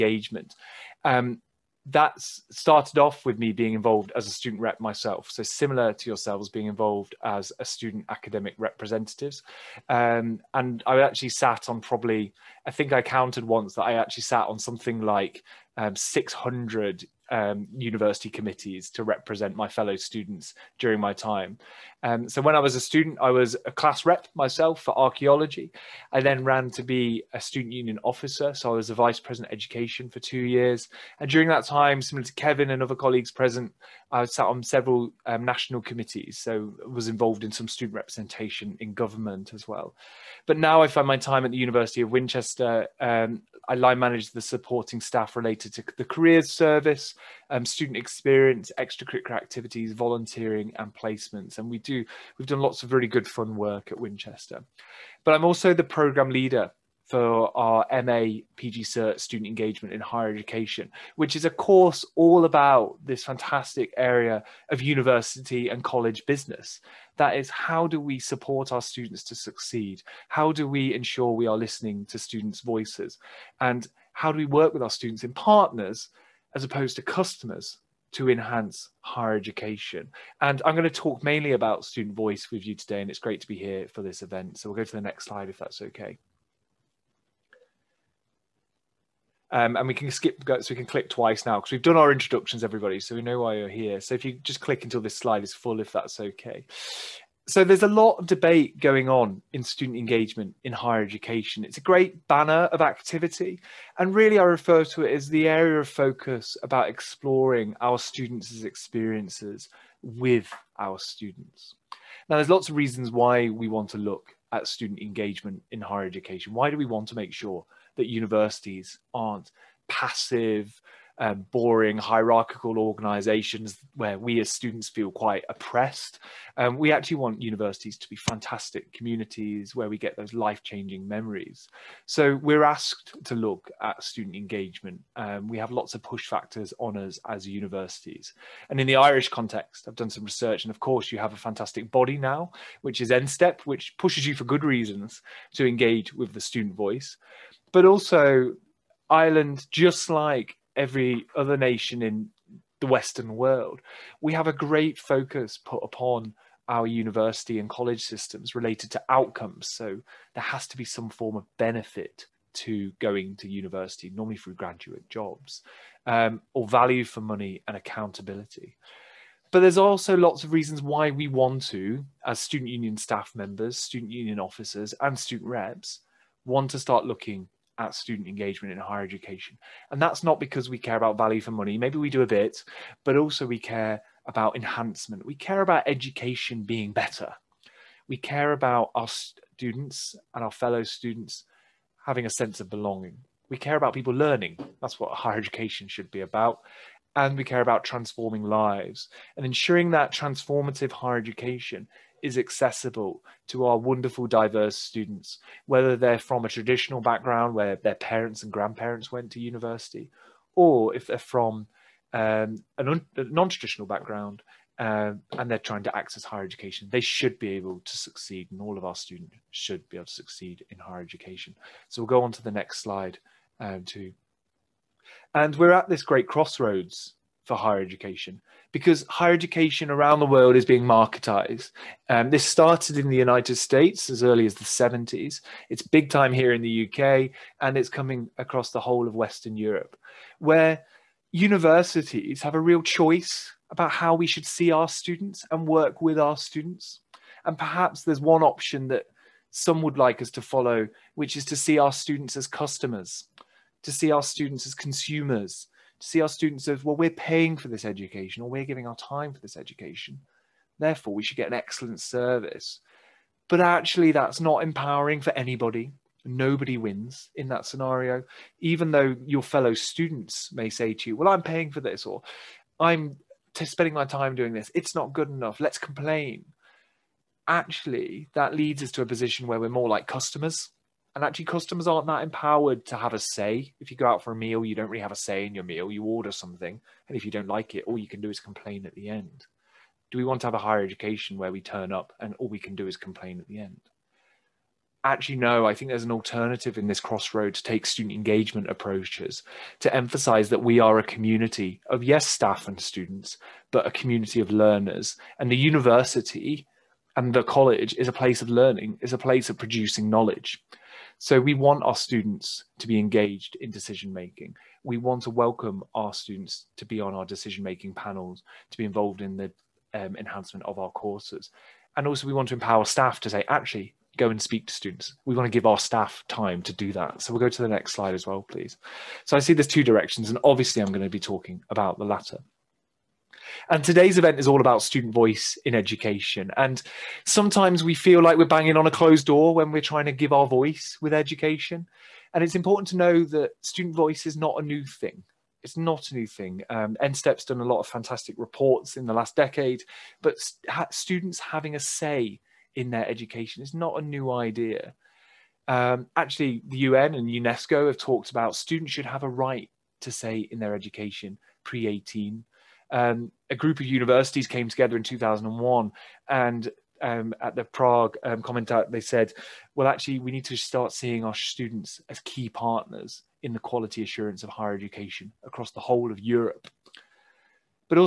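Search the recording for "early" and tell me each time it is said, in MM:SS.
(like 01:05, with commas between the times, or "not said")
03:54.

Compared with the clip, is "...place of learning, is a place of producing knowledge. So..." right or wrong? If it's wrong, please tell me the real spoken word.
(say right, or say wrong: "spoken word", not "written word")
right.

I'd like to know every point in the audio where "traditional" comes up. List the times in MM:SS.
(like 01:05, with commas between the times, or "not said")
03:26, 03:33.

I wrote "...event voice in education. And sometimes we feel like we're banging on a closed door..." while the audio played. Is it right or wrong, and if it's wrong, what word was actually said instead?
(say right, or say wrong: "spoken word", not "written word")
wrong: "student", not "event".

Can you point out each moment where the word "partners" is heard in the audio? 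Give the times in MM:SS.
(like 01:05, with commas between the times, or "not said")
01:15, 06:12.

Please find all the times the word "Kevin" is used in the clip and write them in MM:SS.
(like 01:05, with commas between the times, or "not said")
00:32.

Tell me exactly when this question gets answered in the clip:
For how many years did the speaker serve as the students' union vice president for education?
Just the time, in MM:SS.
00:30.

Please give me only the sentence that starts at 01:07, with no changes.
That is, how do we support our students to succeed?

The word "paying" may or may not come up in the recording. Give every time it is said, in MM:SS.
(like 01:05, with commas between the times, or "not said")
04:17, 04:31.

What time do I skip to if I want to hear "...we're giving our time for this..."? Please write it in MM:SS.
04:18.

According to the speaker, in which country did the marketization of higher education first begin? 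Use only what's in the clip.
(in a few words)
United States.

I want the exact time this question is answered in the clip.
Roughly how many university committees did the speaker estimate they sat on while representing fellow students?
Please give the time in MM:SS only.
00:15.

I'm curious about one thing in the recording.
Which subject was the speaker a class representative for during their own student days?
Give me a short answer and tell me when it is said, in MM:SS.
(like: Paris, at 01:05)
Archaeology, at 00:24.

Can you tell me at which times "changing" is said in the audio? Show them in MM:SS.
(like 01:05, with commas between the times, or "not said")
02:10.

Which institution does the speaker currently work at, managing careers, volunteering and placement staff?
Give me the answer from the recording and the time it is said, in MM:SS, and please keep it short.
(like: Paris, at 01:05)
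University of Winchester, at 00:41.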